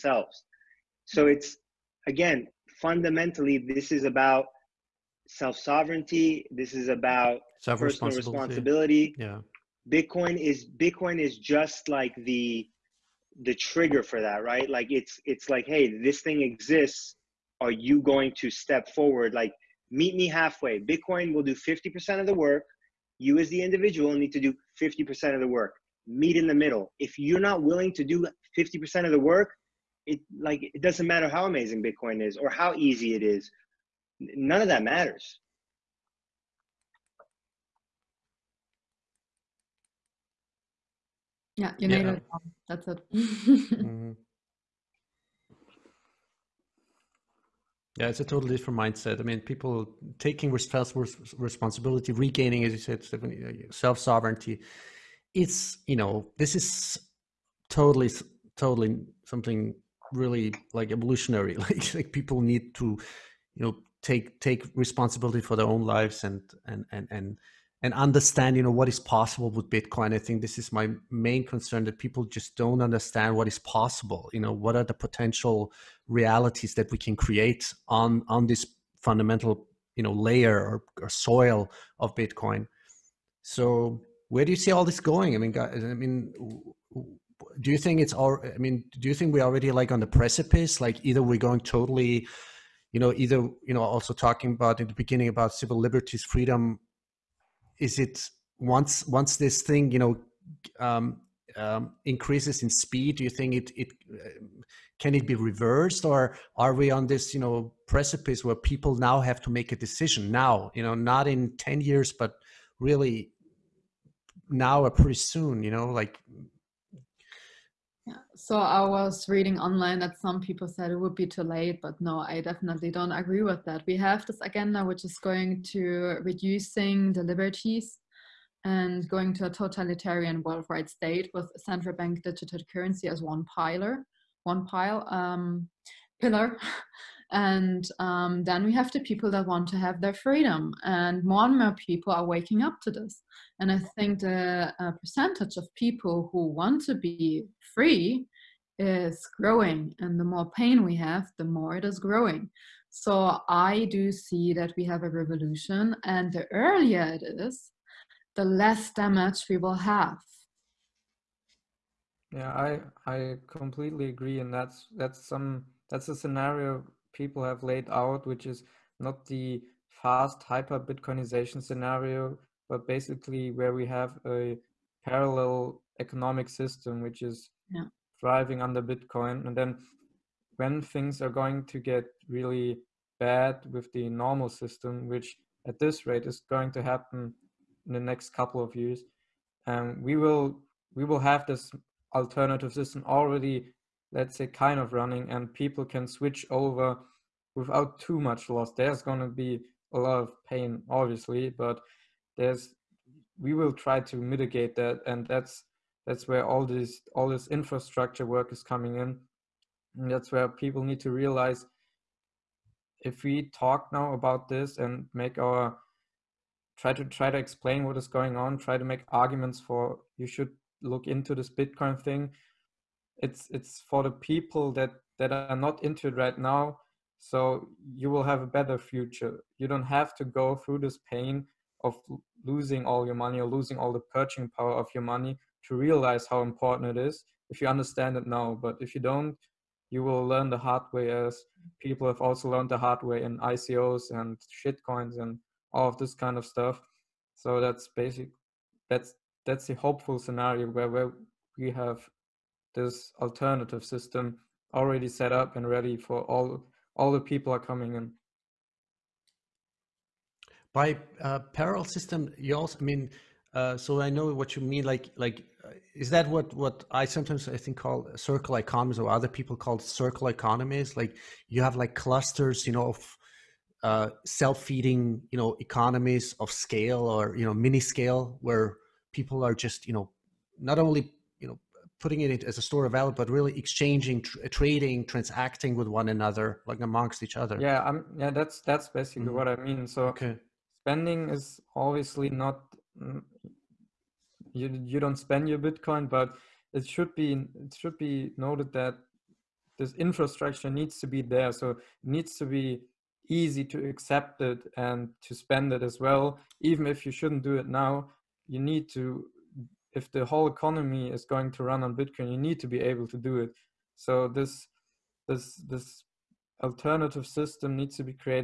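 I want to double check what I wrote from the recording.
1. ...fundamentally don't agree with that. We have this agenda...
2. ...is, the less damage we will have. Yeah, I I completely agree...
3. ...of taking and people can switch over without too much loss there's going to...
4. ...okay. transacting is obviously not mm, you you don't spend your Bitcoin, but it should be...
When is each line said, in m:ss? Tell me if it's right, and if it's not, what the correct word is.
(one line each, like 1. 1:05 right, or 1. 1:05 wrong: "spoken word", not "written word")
1. 2:02 wrong: "definitely", not "fundamentally"
2. 2:37 right
3. 3:14 wrong: "running", not "taking"
4. 4:50 wrong: "spending", not "transacting".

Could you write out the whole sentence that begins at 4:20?
By uh, parallel system, you also I mean.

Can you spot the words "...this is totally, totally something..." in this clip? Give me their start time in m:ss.
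0:56.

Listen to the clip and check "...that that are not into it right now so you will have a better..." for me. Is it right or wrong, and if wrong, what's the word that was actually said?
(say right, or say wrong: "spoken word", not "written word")
right.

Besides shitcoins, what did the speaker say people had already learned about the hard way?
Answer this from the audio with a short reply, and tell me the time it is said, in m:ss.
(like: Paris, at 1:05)
ICOs, at 4:03.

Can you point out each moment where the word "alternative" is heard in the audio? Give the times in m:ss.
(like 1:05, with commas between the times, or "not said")
3:12, 4:13, 5:16.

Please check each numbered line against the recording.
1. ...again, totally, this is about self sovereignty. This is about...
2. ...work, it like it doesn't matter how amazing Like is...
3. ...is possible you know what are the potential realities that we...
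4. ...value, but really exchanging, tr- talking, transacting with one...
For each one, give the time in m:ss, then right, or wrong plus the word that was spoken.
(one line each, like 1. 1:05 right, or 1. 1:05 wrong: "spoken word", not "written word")
1. 0:02 wrong: "fundamentally", not "totally"
2. 0:29 wrong: "Bitcoin", not "Like"
3. 1:13 right
4. 4:42 wrong: "trading", not "talking".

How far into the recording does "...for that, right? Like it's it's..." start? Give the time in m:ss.
0:14.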